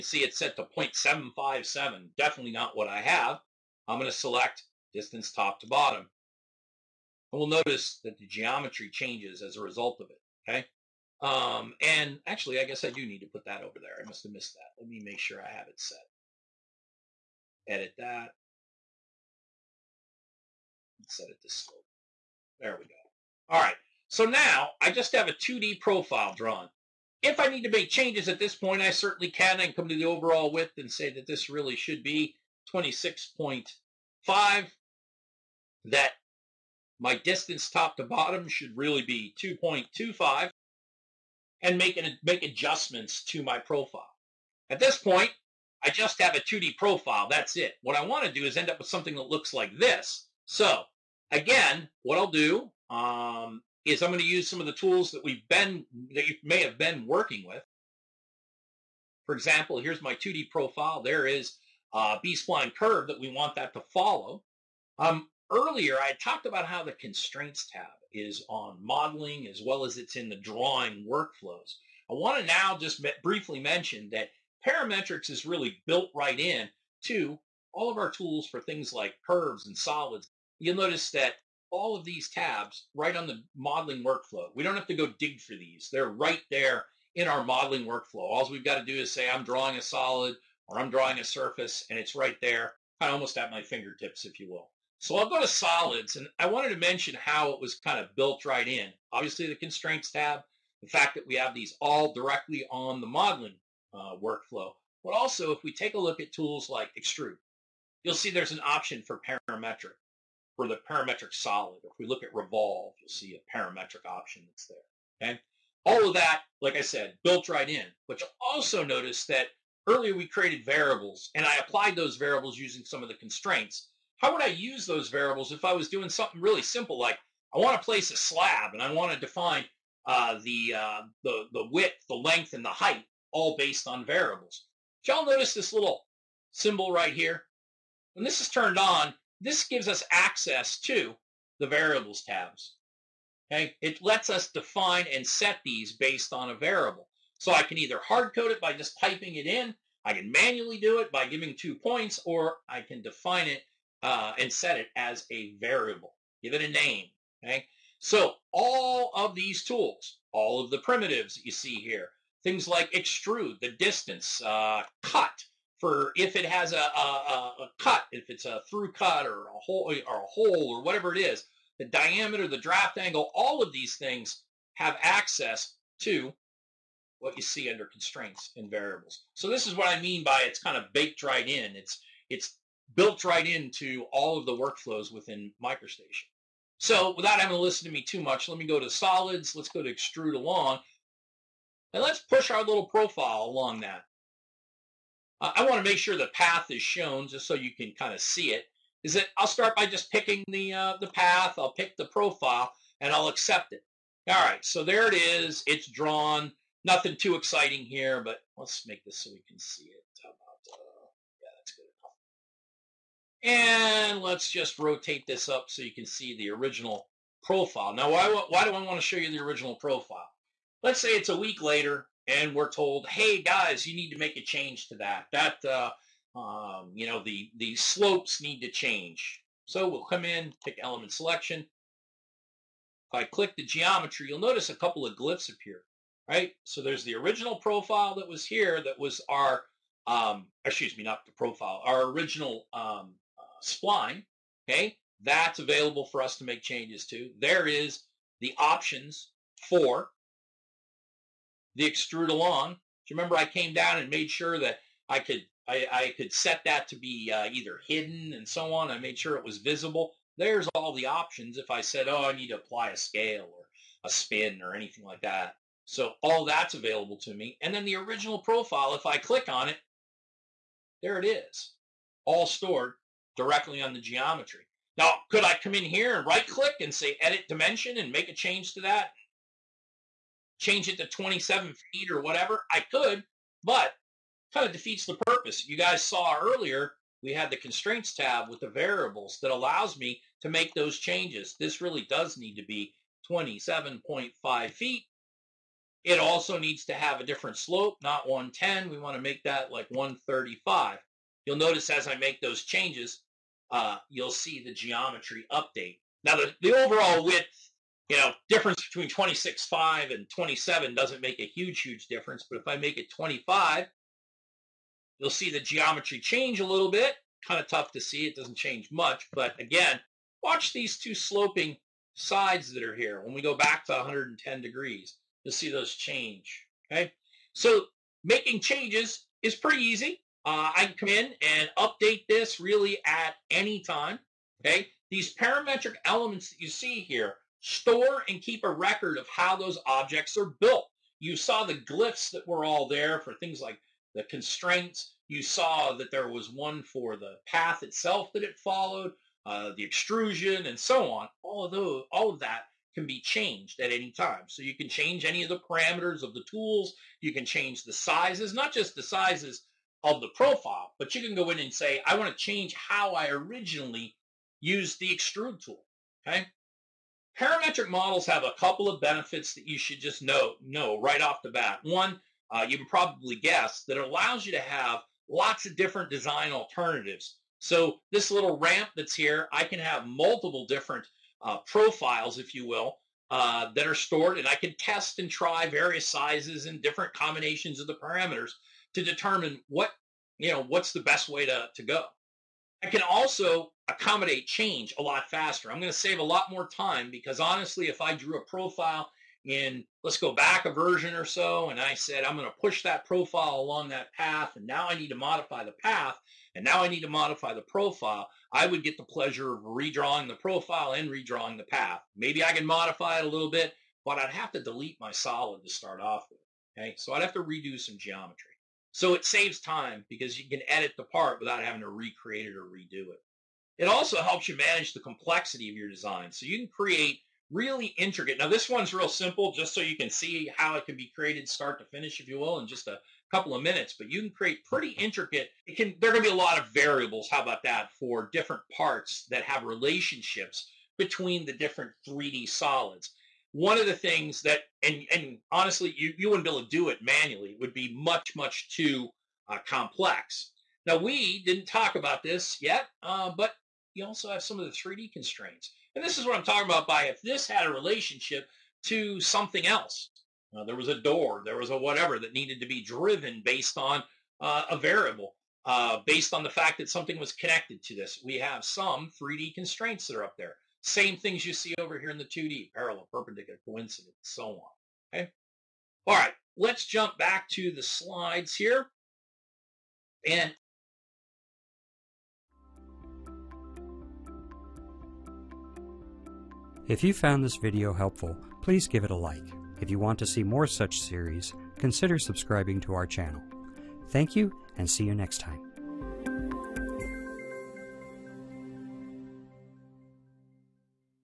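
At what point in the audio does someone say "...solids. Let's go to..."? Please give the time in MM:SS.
03:08.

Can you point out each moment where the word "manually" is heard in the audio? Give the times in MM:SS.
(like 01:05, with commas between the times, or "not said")
02:30, 07:27.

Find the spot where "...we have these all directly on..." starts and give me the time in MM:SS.
01:41.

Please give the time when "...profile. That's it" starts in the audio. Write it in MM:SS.
00:46.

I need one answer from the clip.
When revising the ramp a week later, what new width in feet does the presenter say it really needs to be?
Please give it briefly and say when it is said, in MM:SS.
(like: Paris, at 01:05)
27.5 feet, at 04:53.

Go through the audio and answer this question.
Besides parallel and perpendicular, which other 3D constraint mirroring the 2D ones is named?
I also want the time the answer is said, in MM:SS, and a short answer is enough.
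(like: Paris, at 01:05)
Coincidence, at 07:53.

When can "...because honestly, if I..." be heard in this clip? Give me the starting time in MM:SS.
06:37.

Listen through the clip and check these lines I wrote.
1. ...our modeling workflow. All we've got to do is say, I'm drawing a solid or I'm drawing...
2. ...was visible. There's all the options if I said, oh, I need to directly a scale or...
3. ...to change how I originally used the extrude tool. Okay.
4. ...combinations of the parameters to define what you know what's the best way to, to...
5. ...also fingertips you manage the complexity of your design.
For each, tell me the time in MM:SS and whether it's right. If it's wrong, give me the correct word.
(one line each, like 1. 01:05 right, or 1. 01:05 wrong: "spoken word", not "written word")
1. 01:27 right
2. 04:19 wrong: "apply", not "directly"
3. 06:02 right
4. 06:27 wrong: "determine", not "define"
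5. 07:03 wrong: "helps", not "fingertips".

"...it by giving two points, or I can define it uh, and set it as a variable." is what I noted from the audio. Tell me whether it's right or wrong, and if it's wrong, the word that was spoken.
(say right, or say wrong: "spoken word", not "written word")
right.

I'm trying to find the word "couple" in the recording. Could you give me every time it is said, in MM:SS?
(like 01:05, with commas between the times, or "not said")
03:54, 06:08, 07:13.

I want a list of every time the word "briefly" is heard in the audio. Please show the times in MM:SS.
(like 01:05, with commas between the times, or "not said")
01:13.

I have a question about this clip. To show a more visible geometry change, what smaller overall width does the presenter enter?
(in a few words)
25.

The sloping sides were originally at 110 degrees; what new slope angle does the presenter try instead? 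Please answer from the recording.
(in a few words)
135.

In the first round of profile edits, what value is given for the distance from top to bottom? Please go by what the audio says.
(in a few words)
2.25.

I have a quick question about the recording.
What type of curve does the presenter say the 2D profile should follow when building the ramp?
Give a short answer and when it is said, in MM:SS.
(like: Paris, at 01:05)
B-spline curve, at 01:02.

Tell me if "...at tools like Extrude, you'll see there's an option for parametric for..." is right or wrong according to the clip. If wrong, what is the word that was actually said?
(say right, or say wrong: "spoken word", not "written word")
right.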